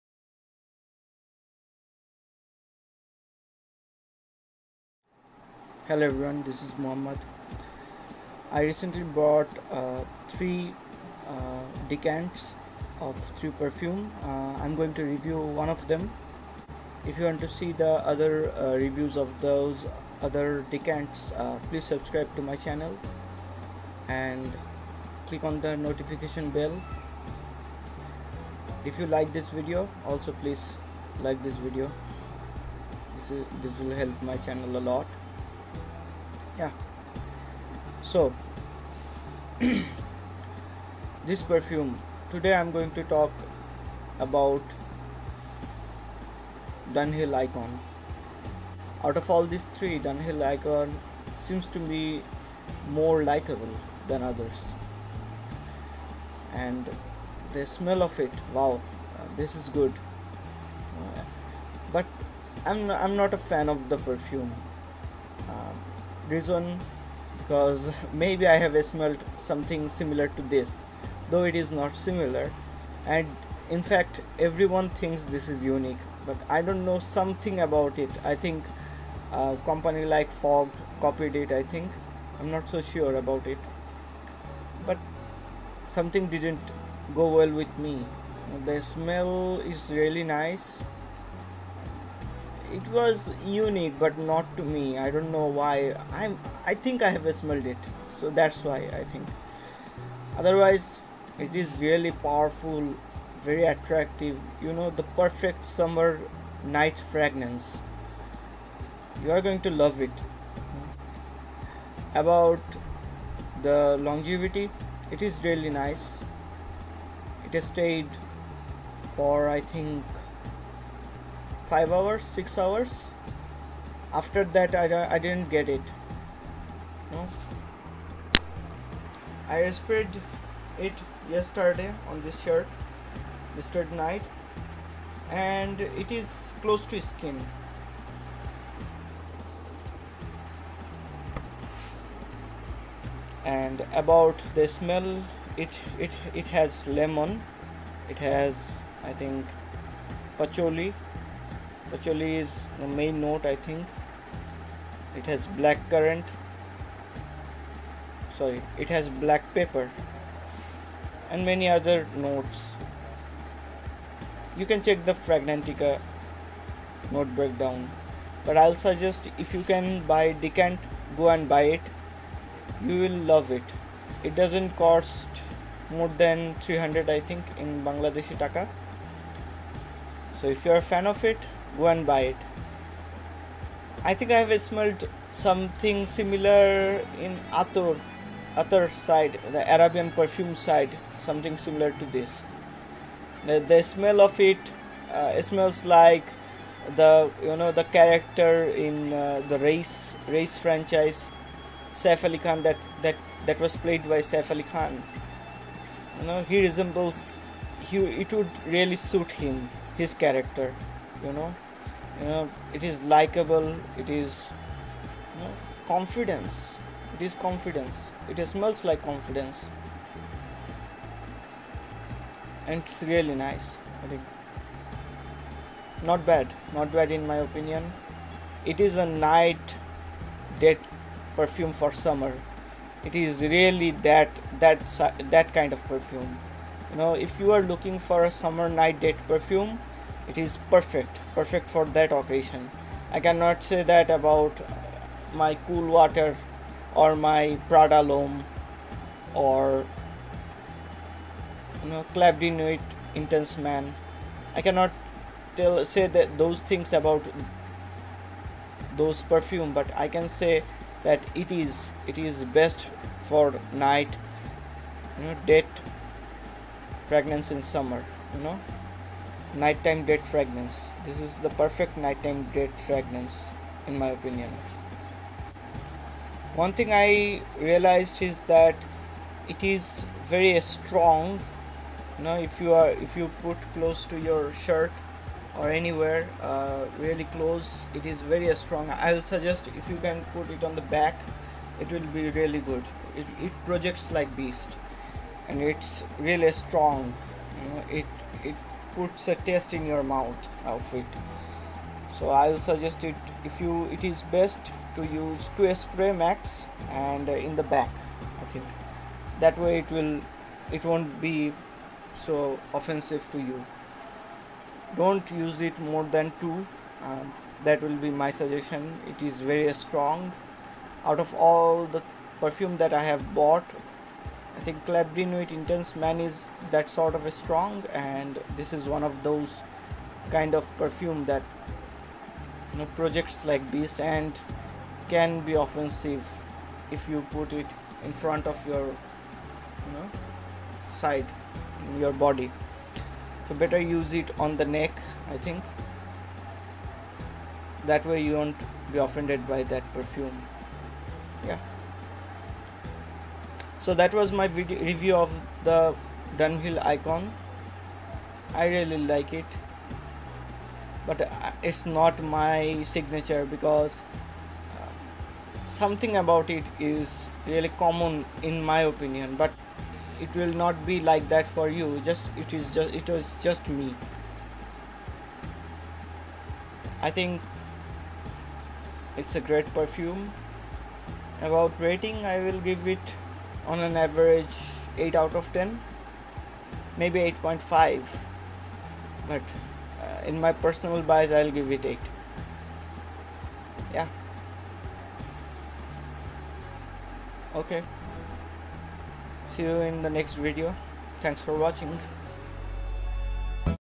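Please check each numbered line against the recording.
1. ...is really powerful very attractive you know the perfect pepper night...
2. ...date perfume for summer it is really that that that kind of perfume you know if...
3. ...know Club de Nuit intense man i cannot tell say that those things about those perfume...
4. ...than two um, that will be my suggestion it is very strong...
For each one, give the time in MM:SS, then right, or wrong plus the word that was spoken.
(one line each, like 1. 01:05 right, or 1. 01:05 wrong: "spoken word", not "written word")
1. 01:41 wrong: "summer", not "pepper"
2. 03:50 right
3. 04:11 right
4. 05:16 right.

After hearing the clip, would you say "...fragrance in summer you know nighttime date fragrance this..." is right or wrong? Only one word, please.
right.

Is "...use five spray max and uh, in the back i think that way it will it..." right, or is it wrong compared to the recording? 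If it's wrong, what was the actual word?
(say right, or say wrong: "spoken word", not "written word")
wrong: "two", not "five".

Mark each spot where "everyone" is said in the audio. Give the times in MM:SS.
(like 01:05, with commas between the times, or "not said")
00:06, 01:14.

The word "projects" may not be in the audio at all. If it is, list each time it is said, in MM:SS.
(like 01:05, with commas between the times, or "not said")
04:53, 05:32.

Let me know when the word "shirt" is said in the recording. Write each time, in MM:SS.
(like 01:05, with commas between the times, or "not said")
02:12, 04:44.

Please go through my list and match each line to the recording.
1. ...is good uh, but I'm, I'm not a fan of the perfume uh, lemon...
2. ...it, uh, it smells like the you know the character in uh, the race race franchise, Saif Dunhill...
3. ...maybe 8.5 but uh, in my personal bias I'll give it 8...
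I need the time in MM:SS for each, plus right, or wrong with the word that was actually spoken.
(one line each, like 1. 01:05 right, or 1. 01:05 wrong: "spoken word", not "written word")
1. 00:59 wrong: "reason", not "lemon"
2. 03:14 wrong: "Ali", not "Dunhill"
3. 06:26 right.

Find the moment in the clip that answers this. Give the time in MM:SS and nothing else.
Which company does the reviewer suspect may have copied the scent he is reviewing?
01:20.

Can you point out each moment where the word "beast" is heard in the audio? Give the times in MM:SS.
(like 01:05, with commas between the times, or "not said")
04:54.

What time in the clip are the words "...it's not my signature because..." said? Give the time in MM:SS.
06:01.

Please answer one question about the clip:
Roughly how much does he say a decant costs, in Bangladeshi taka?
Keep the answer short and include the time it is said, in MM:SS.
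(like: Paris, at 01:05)
300, at 02:56.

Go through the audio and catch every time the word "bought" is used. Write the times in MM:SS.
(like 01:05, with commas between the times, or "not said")
00:09, 05:23.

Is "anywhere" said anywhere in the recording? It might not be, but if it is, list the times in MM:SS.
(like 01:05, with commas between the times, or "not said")
04:45.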